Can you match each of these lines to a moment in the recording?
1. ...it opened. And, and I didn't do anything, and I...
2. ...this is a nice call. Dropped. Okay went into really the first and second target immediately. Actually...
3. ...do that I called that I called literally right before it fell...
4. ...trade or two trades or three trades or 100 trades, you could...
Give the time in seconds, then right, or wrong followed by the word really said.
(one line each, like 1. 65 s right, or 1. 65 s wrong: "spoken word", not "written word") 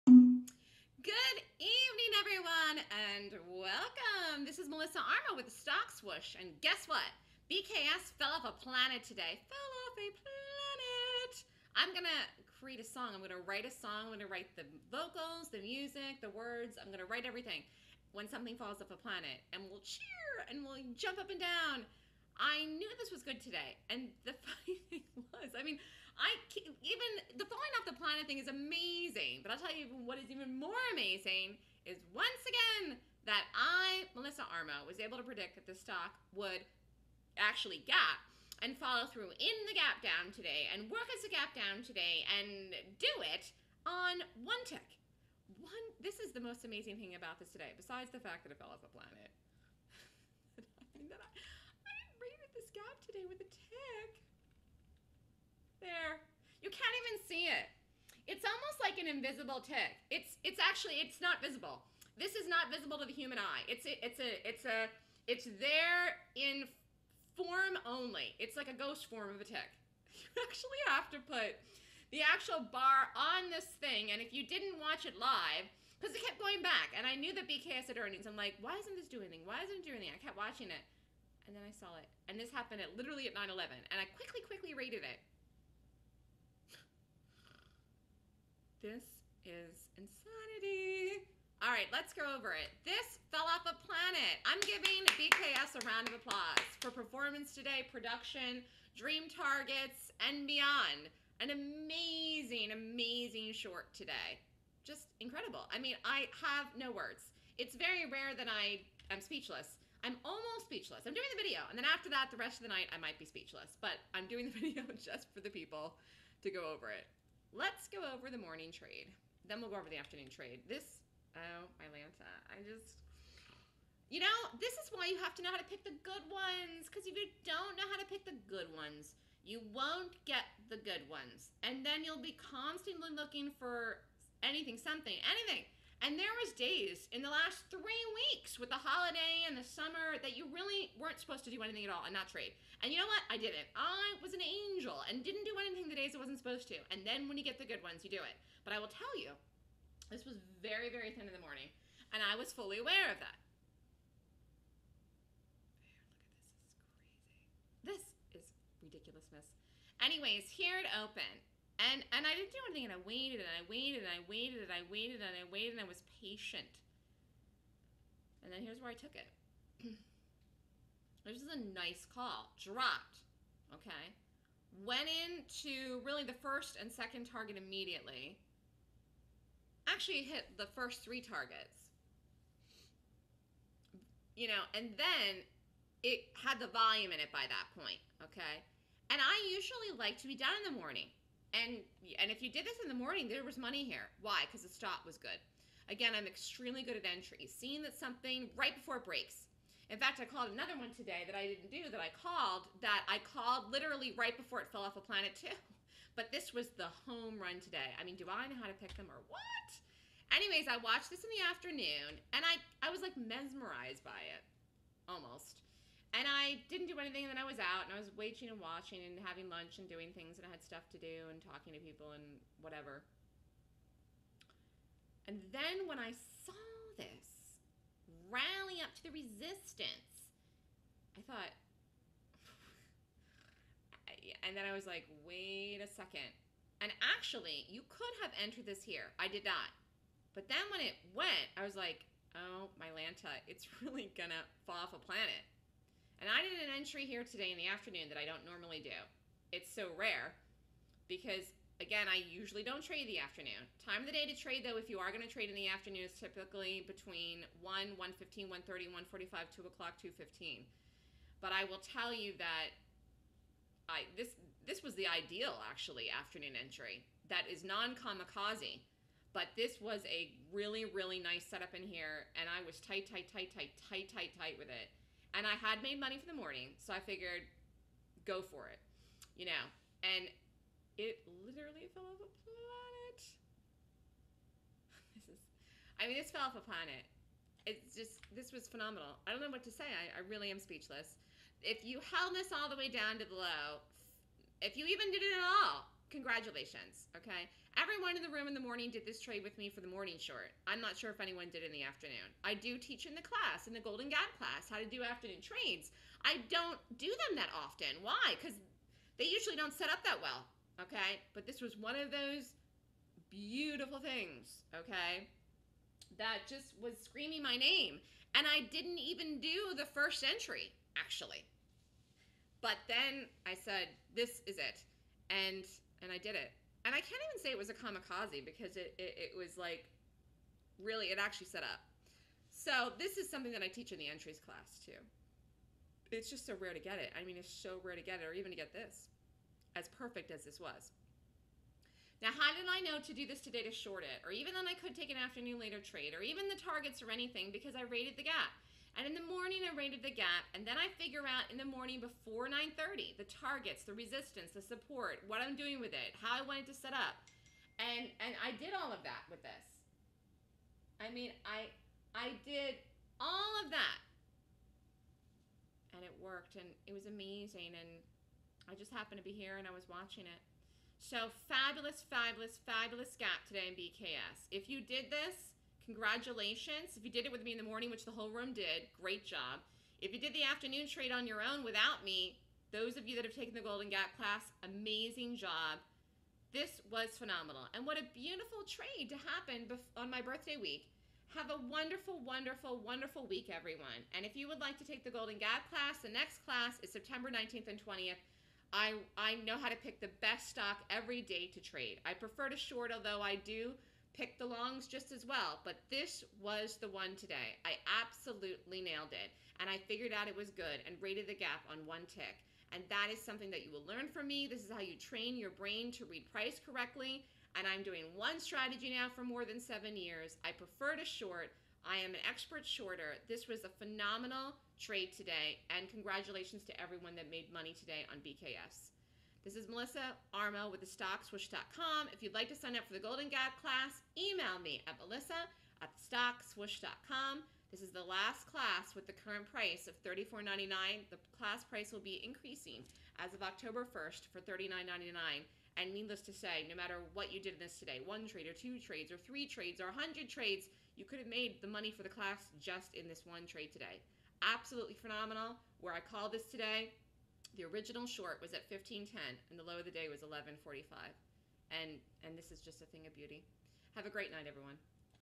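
1. 160 s right
2. 171 s right
3. 201 s right
4. 448 s right.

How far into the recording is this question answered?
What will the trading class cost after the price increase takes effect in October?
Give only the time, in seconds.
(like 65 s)
444 s.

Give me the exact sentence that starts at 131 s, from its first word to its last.
And then you'll be constantly looking for anything, something, anything.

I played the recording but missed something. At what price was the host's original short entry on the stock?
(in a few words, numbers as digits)
15.10.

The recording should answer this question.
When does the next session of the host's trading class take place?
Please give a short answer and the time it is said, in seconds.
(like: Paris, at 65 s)
September 19th and 20th, at 396 s.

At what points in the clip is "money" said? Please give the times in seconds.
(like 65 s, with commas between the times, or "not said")
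193 s, 275 s, 427 s, 451 s.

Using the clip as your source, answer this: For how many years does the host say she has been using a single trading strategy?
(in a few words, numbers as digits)
more than 7 years.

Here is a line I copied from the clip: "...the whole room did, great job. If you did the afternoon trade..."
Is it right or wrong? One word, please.
right.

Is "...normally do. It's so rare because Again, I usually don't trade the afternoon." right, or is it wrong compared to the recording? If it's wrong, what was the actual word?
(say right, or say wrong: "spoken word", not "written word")
right.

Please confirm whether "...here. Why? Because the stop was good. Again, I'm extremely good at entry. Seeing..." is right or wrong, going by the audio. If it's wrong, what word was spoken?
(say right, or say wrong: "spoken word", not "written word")
right.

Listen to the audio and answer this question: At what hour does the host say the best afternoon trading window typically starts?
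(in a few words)
1 o'clock.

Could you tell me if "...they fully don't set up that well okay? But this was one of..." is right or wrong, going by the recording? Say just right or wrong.
wrong.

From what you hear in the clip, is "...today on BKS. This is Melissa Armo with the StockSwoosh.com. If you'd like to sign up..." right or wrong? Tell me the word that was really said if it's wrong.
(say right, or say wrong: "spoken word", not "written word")
right.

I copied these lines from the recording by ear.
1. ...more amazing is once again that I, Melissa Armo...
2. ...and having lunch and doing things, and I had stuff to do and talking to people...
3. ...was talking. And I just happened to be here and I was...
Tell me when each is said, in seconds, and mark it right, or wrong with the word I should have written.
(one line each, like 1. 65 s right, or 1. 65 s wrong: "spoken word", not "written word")
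1. 30 s right
2. 219 s right
3. 366 s wrong: "amazing", not "talking".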